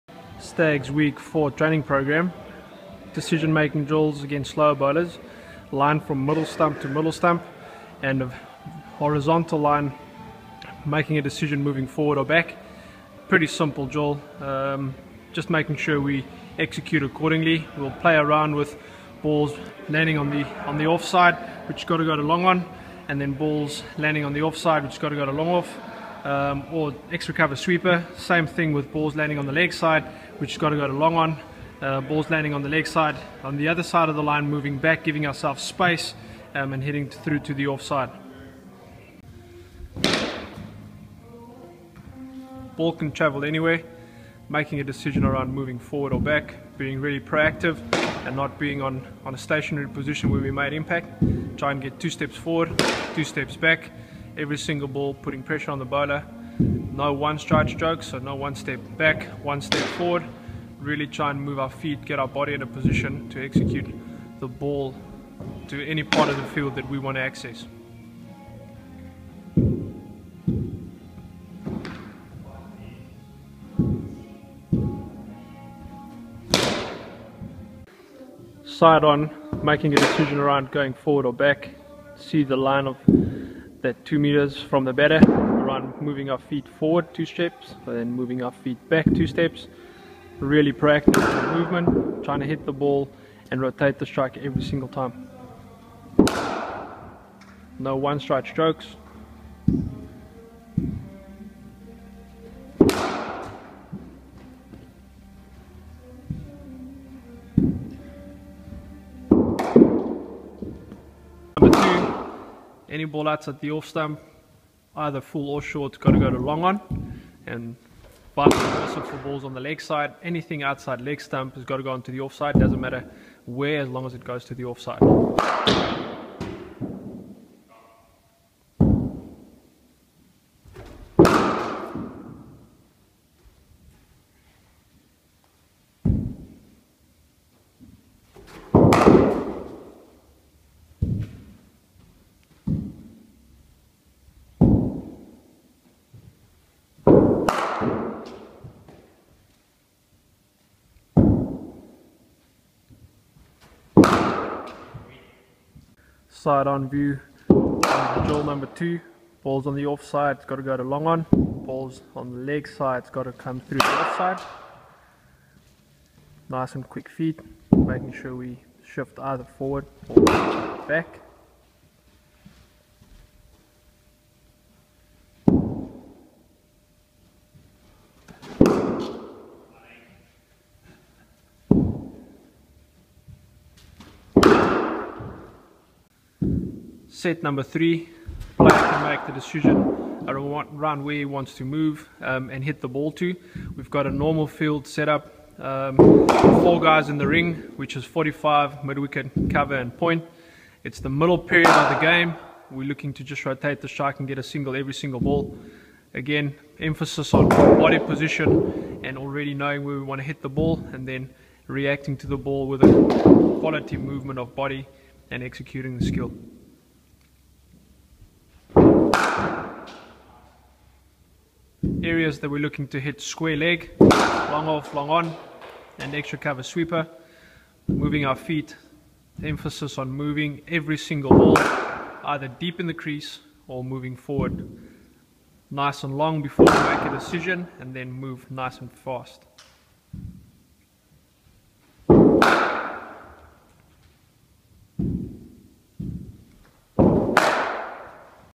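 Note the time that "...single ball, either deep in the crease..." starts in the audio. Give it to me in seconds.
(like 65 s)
230 s.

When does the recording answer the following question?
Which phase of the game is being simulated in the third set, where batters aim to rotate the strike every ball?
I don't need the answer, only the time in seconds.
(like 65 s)
201 s.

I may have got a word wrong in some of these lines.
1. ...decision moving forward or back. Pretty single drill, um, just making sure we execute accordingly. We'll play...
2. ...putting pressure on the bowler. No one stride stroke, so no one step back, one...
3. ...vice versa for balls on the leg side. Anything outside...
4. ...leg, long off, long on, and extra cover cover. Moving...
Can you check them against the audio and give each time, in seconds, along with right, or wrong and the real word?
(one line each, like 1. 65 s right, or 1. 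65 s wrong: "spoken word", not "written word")
1. 11 s wrong: "simple", not "single"
2. 55 s right
3. 118 s right
4. 223 s wrong: "sweeper", not "cover".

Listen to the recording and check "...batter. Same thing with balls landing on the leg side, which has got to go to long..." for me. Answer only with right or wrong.
wrong.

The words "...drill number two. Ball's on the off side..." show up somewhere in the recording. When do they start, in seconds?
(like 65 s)
157 s.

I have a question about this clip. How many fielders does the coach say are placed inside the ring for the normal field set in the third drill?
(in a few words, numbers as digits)
4.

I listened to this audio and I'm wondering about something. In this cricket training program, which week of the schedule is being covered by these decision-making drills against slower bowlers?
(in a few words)
Week 4.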